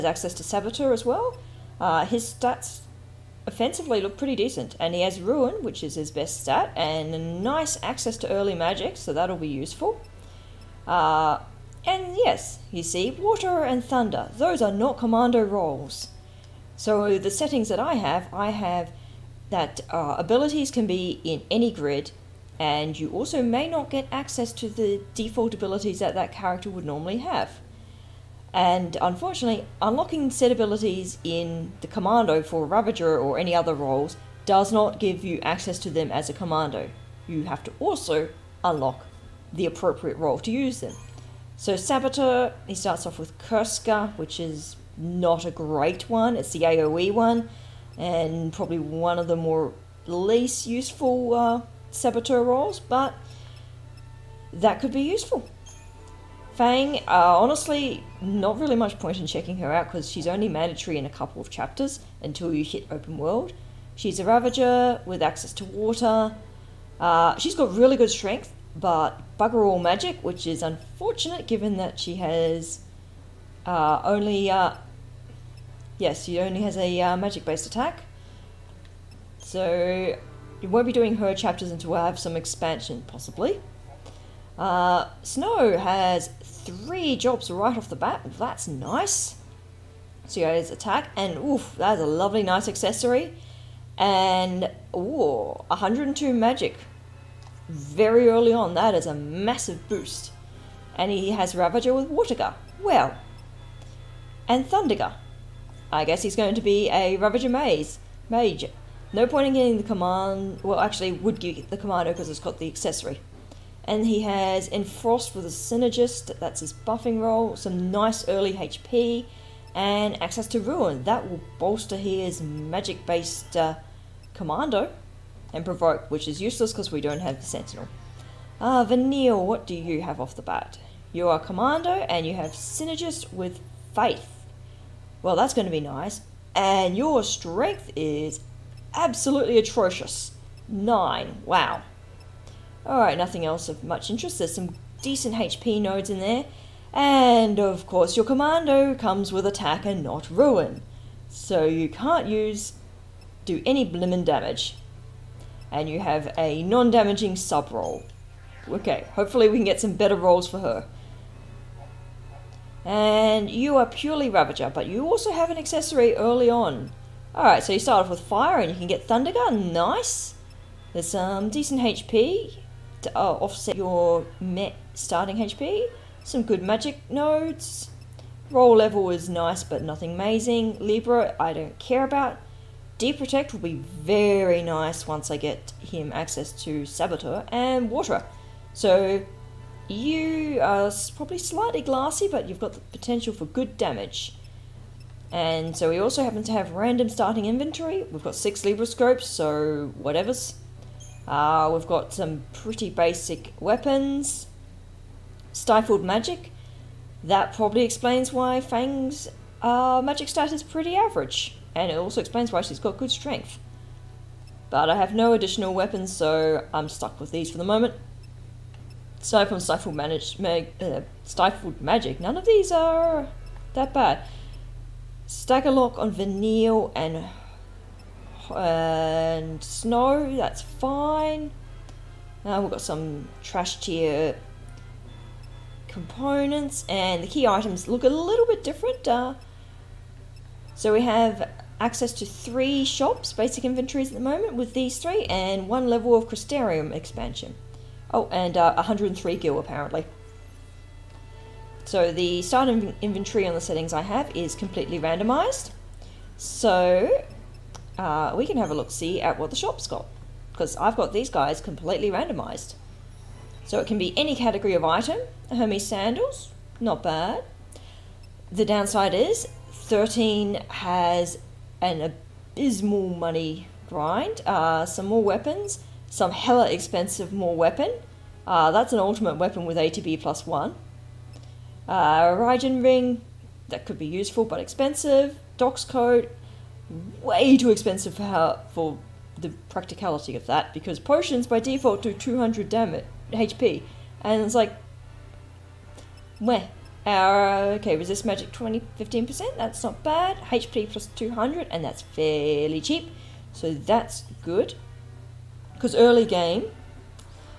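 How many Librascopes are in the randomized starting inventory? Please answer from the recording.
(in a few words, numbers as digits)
6.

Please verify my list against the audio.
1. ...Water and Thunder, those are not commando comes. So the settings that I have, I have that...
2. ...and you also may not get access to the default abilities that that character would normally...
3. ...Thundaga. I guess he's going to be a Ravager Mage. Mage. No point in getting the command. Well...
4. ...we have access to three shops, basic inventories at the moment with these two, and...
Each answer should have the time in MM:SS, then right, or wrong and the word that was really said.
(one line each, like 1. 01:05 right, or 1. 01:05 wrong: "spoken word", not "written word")
1. 00:13 wrong: "roles", not "comes"
2. 00:22 right
3. 01:44 right
4. 04:00 wrong: "three", not "two".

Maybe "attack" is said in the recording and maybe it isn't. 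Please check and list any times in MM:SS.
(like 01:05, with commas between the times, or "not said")
01:17, 01:30, 02:29.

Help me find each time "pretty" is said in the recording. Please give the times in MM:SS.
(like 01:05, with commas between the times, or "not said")
00:04, 03:22, 03:30.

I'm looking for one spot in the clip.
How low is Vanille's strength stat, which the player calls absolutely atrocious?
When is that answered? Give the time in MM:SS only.
02:20.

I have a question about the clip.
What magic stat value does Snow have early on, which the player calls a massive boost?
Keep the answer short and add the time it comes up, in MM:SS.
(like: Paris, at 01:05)
102, at 01:35.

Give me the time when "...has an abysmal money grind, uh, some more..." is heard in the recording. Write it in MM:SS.
04:30.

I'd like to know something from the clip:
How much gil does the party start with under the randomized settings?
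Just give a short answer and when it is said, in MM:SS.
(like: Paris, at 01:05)
103, at 04:08.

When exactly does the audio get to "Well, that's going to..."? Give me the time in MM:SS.
02:15.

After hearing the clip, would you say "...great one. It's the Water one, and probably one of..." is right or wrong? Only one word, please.
wrong.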